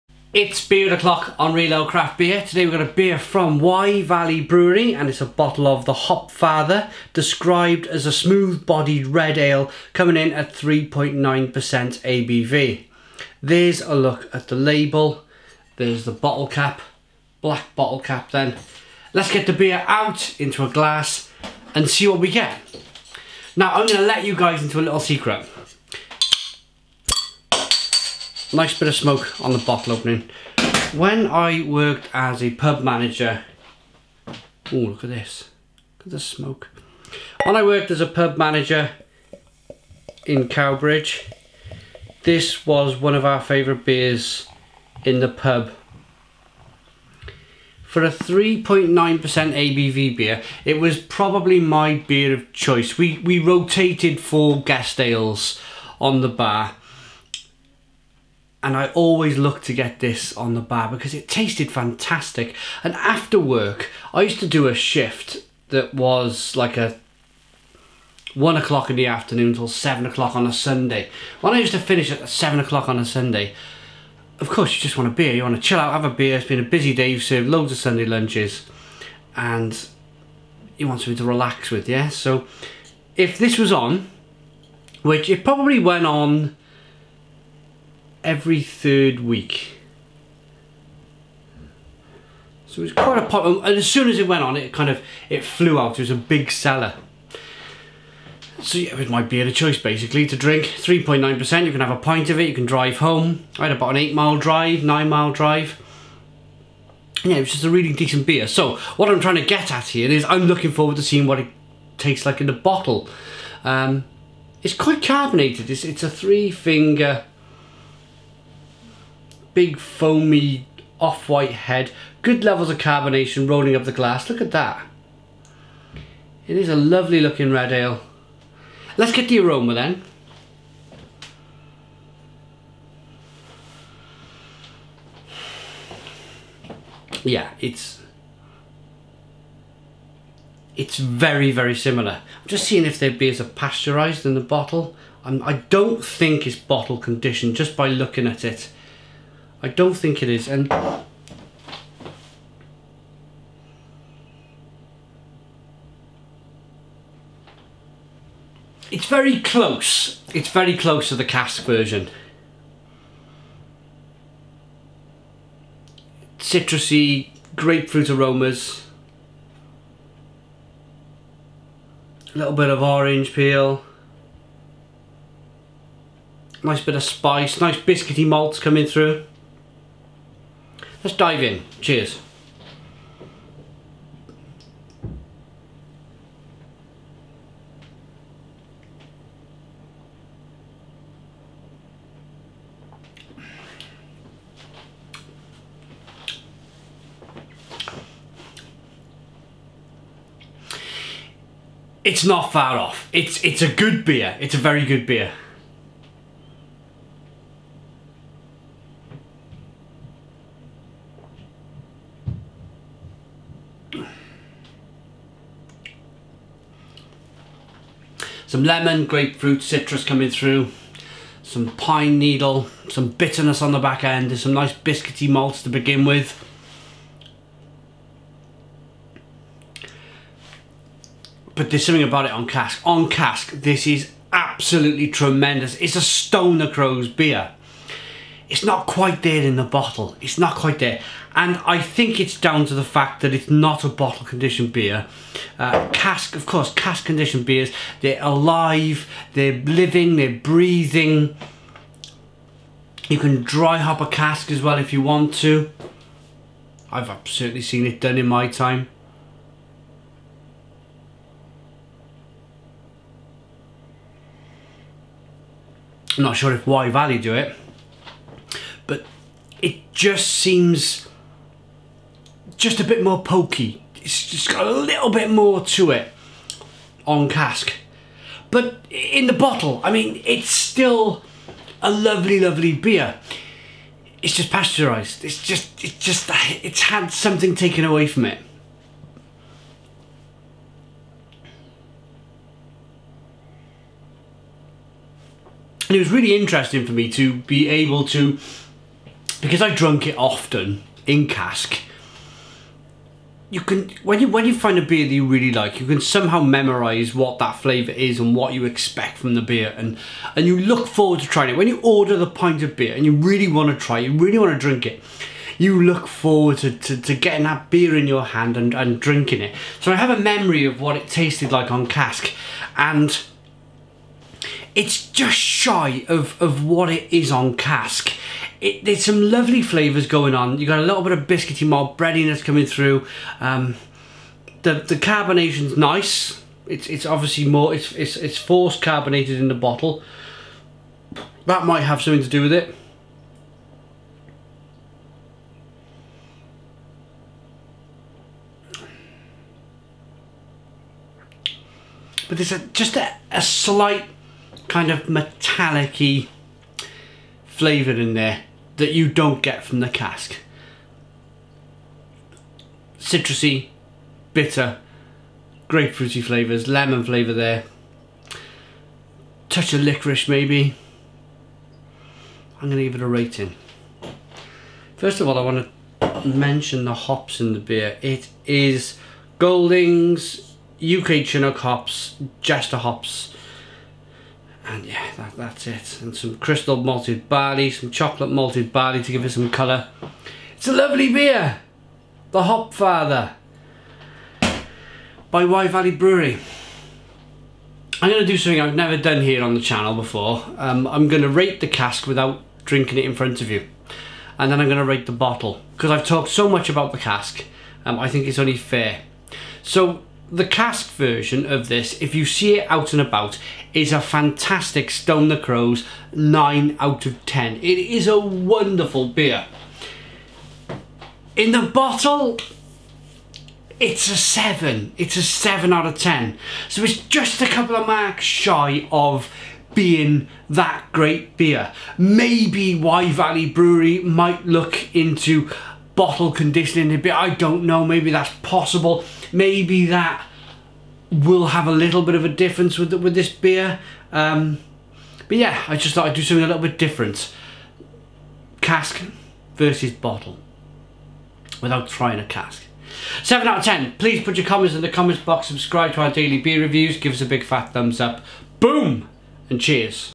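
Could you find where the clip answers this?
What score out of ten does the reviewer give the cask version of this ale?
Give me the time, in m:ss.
6:56.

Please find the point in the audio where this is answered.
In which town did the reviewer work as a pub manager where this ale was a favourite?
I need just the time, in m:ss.
0:40.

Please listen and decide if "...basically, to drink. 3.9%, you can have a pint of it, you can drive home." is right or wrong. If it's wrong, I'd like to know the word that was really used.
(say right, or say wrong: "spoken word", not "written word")
right.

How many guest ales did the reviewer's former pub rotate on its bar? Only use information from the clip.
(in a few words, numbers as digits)
4.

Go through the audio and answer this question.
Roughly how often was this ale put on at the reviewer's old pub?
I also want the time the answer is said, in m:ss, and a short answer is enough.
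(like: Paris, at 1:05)
Every third week, at 1:28.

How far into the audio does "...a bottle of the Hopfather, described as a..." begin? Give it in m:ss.
0:05.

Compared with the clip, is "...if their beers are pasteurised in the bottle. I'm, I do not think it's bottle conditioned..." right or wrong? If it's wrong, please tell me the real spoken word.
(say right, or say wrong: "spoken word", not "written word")
right.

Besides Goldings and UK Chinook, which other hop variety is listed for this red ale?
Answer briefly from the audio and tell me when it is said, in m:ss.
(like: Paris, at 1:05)
Jester, at 6:22.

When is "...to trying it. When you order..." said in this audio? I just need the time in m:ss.
5:11.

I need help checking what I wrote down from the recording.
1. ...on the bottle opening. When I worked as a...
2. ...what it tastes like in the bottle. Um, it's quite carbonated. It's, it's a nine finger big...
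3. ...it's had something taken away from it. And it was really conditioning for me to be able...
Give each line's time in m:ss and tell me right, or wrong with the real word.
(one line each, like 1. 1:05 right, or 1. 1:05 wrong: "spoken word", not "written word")
1. 0:29 right
2. 1:51 wrong: "three", not "nine"
3. 4:46 wrong: "interesting", not "conditioning".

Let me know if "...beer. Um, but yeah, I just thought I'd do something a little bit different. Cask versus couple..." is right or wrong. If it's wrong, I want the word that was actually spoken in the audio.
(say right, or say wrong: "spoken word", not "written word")
wrong: "bottle", not "couple".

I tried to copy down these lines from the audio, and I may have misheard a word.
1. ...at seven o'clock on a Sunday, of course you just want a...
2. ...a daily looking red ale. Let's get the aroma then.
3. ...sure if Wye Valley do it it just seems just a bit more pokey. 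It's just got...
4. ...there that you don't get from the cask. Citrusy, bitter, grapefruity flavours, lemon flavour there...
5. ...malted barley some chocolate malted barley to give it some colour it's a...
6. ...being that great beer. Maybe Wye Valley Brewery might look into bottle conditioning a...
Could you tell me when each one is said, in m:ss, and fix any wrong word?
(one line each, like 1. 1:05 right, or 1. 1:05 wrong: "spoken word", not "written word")
1. 1:12 right
2. 2:06 wrong: "lovely", not "daily"
3. 4:26 right
4. 5:58 right
5. 6:26 right
6. 7:09 right.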